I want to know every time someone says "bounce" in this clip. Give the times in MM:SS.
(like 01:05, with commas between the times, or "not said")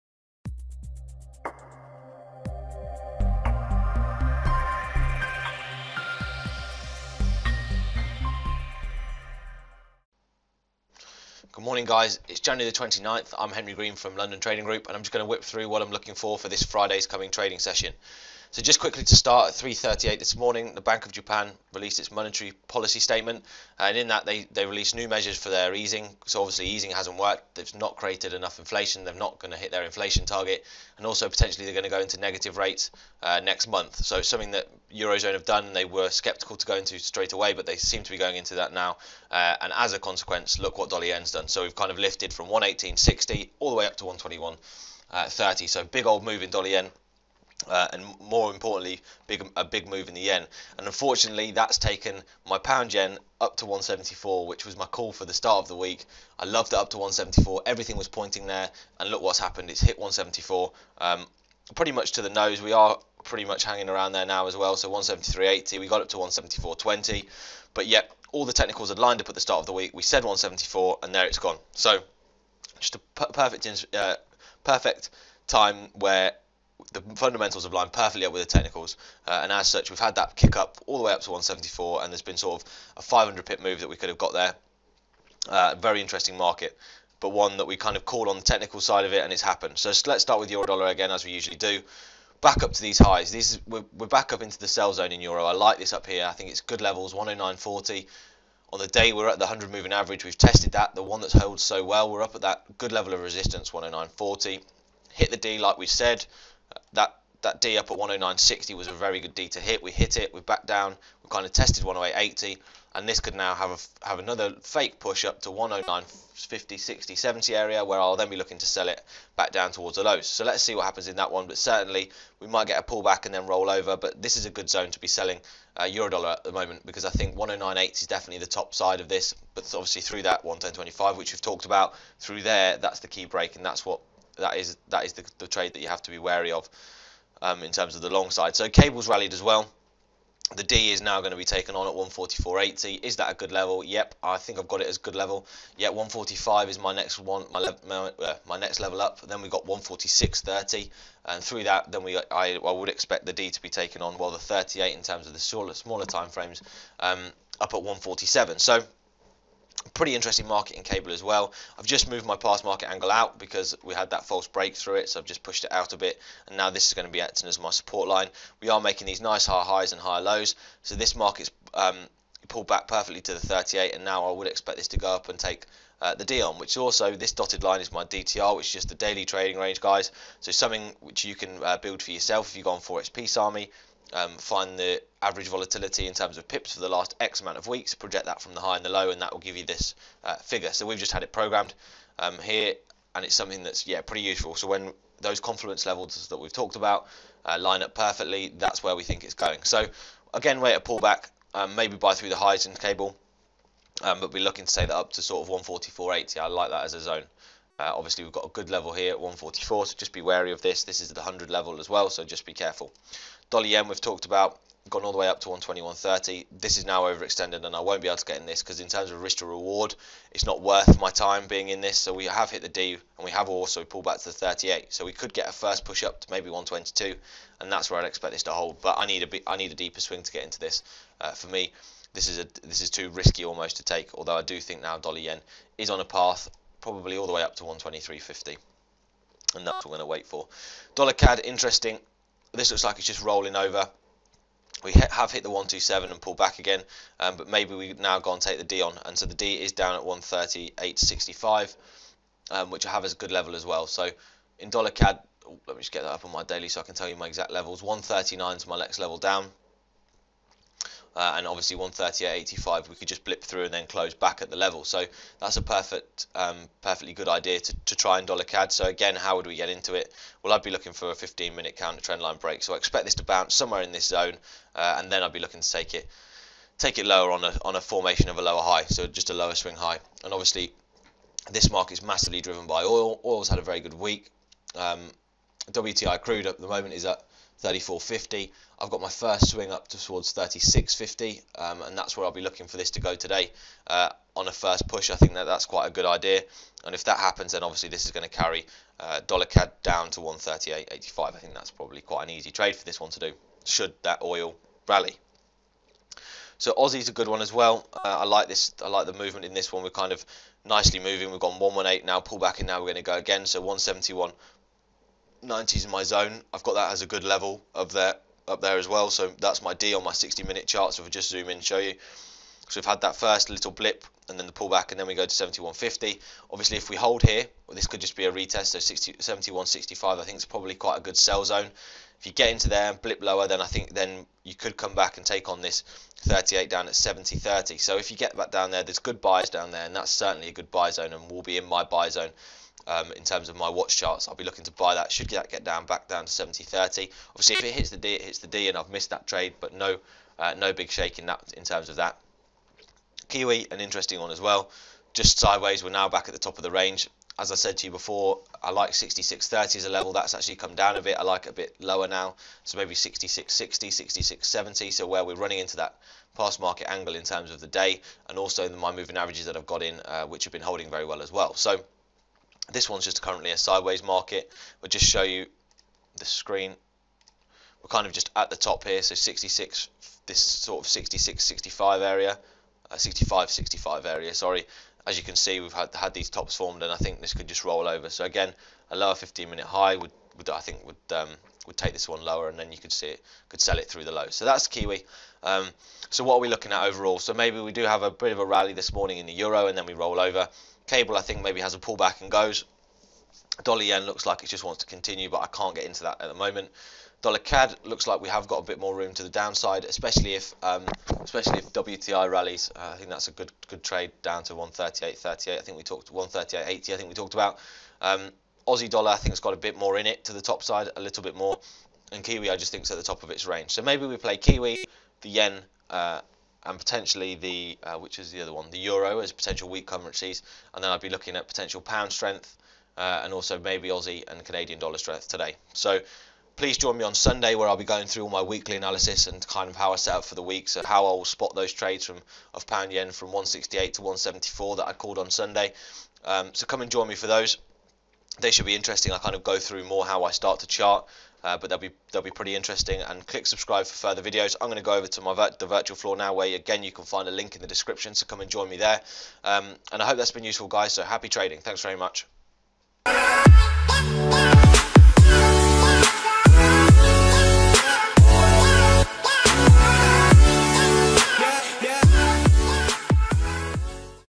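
04:33.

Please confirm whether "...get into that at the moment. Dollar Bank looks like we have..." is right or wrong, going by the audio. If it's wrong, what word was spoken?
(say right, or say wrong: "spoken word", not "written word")
wrong: "CAD", not "Bank".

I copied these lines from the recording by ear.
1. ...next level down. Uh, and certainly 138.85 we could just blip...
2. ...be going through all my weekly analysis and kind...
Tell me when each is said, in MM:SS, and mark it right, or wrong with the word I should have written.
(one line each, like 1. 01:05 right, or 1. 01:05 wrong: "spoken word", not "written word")
1. 04:18 wrong: "obviously", not "certainly"
2. 07:17 right.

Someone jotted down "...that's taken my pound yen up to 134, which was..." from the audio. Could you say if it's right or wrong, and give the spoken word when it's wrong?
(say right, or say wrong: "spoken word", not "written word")
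wrong: "174", not "134".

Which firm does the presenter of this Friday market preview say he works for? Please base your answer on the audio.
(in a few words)
London Trading Group.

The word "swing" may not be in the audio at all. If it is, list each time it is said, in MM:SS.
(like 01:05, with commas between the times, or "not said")
03:50, 04:39, 04:49.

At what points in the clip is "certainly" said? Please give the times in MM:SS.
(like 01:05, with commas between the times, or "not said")
02:01, 05:40.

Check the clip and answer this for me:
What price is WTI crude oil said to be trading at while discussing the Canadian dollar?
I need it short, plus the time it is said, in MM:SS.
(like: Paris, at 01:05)
34.50, at 04:47.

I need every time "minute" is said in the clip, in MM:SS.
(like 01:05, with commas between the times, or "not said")
04:31, 05:20, 06:29.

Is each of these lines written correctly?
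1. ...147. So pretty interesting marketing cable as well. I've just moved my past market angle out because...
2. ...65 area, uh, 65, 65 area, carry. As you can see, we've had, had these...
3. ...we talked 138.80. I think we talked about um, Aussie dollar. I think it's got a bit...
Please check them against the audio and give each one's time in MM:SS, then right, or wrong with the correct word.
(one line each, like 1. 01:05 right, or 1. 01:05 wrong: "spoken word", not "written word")
1. 02:37 right
2. 06:21 wrong: "sorry", not "carry"
3. 06:55 right.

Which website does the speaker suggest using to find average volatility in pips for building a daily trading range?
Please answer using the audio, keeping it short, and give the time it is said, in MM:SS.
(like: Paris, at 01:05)
Forex Peace Army, at 03:02.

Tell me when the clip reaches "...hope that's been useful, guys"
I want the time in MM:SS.
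07:40.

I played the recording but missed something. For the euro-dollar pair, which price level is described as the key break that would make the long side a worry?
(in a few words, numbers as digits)
110.25.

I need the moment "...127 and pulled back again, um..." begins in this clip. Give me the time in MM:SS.
04:05.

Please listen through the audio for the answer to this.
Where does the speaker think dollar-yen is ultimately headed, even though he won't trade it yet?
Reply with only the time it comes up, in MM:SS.
03:57.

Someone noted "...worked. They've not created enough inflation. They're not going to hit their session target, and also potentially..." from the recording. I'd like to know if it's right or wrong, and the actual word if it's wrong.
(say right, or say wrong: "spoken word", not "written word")
wrong: "inflation", not "session".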